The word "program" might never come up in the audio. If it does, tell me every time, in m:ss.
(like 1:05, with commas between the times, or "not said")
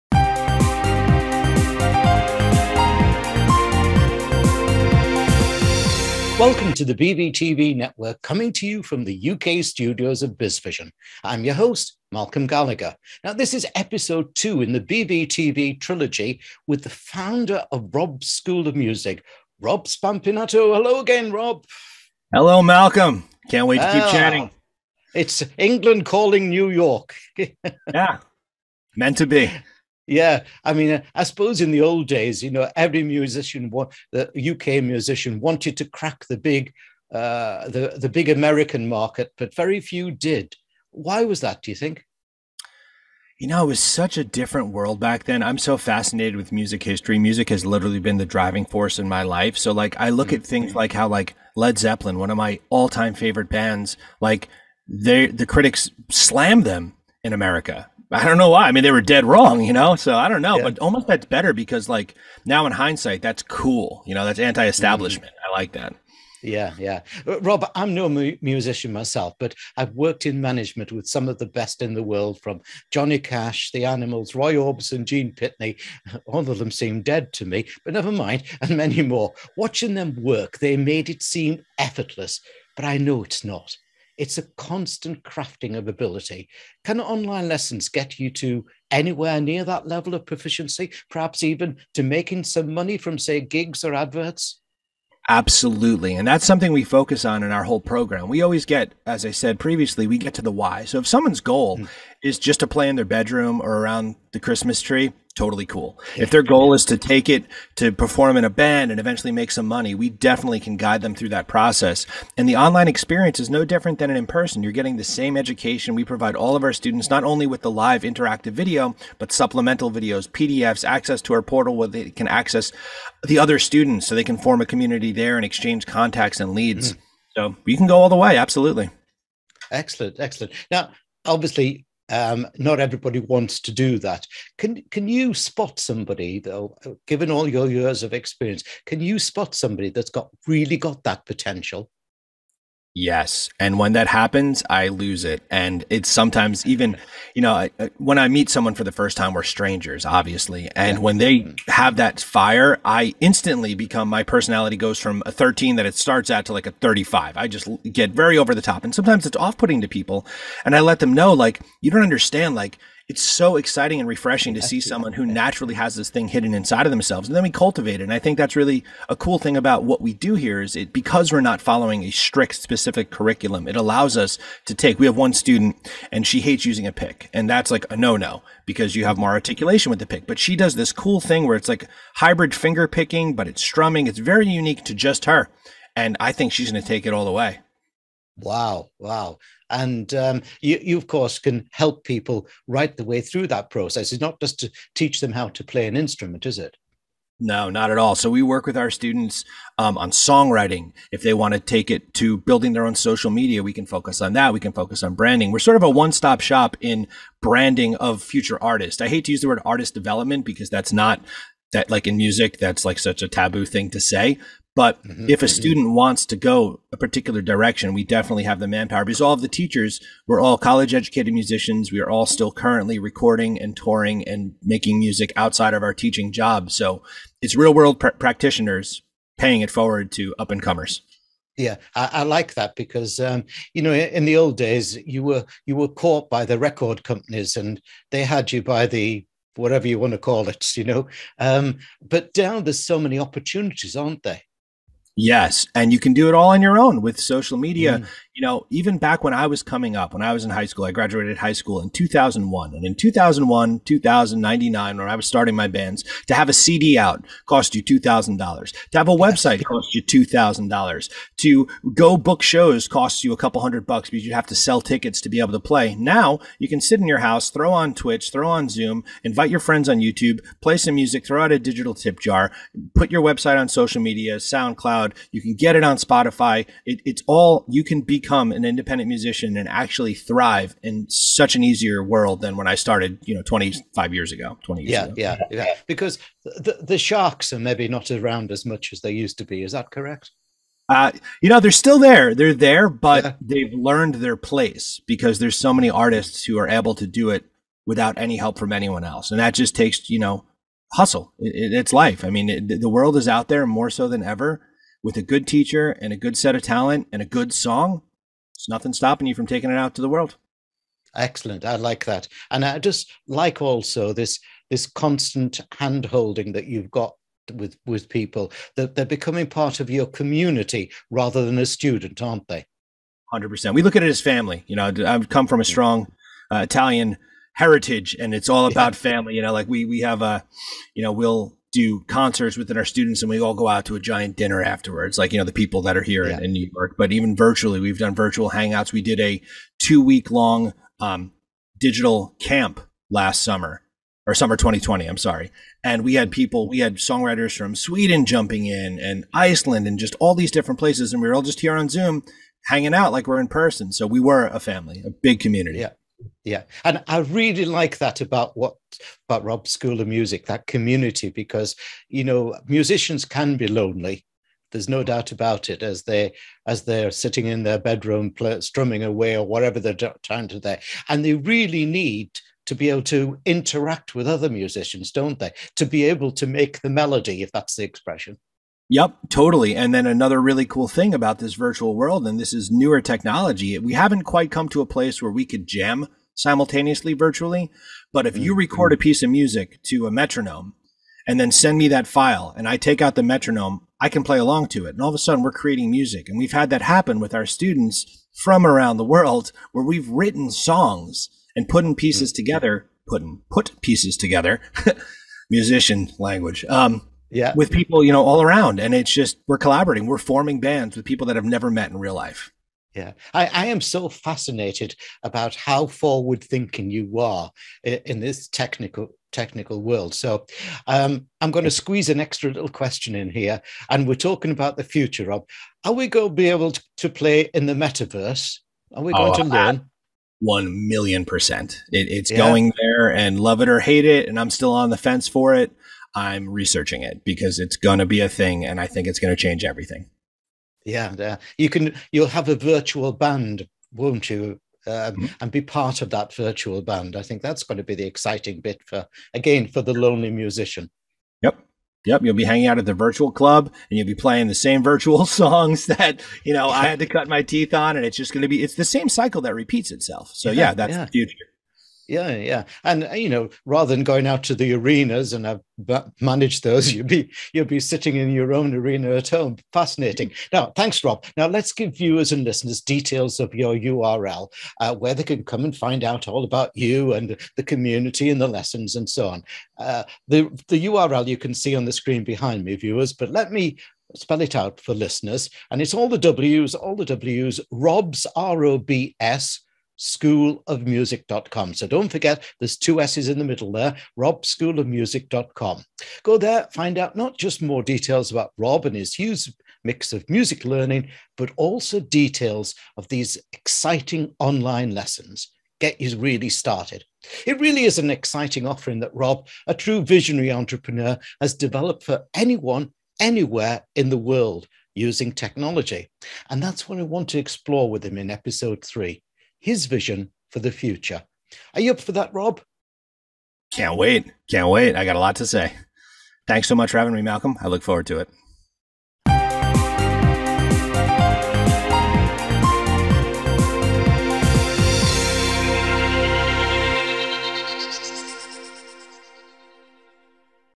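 1:37.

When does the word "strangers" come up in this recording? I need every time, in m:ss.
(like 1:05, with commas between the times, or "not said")
2:29.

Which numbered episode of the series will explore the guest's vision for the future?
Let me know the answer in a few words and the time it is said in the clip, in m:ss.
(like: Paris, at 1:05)
Episode 3, at 8:38.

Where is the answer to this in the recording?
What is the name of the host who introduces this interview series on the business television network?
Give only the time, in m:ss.
0:12.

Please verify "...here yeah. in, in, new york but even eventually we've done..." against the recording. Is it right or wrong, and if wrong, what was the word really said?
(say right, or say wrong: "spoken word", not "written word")
wrong: "virtually", not "eventually".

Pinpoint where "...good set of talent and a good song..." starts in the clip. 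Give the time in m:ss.
5:06.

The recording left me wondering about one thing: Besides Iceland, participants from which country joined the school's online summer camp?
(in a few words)
Sweden.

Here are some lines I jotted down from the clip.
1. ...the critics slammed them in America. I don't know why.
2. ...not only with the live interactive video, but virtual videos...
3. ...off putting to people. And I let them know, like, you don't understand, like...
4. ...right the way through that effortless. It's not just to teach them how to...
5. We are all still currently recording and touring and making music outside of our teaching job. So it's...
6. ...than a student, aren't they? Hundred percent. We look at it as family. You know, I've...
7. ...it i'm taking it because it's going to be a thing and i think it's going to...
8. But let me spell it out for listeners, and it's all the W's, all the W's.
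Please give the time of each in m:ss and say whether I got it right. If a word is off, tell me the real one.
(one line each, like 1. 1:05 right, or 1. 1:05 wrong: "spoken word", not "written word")
1. 0:55 right
2. 1:57 wrong: "supplemental", not "virtual"
3. 2:39 right
4. 3:12 wrong: "process", not "effortless"
5. 3:41 right
6. 5:21 right
7. 7:15 wrong: "researching", not "taking"
8. 8:03 right.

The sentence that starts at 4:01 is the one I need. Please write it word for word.
Um, but now there's so many opportunities, aren't there?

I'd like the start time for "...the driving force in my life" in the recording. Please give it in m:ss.
0:48.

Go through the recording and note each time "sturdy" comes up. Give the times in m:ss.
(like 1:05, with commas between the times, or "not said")
not said.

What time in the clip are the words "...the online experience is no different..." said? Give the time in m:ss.
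1:52.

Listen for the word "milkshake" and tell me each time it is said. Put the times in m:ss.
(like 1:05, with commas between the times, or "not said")
not said.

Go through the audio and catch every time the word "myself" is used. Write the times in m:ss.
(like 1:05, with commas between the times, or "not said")
1:08.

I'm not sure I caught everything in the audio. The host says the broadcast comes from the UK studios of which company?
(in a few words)
BizVision.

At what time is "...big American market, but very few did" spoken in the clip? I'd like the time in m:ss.
0:38.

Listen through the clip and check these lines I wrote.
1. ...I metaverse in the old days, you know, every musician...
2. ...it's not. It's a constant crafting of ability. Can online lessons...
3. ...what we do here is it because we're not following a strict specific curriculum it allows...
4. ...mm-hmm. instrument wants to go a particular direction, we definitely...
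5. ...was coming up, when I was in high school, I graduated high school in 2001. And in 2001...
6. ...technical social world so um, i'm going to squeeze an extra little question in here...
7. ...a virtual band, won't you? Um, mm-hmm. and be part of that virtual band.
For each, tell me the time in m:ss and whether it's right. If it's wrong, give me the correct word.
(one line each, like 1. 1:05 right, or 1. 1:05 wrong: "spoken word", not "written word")
1. 0:31 wrong: "suppose", not "metaverse"
2. 1:23 right
3. 2:49 right
4. 3:35 wrong: "student", not "instrument"
5. 4:09 right
6. 6:58 wrong: "technical", not "social"
7. 7:22 right.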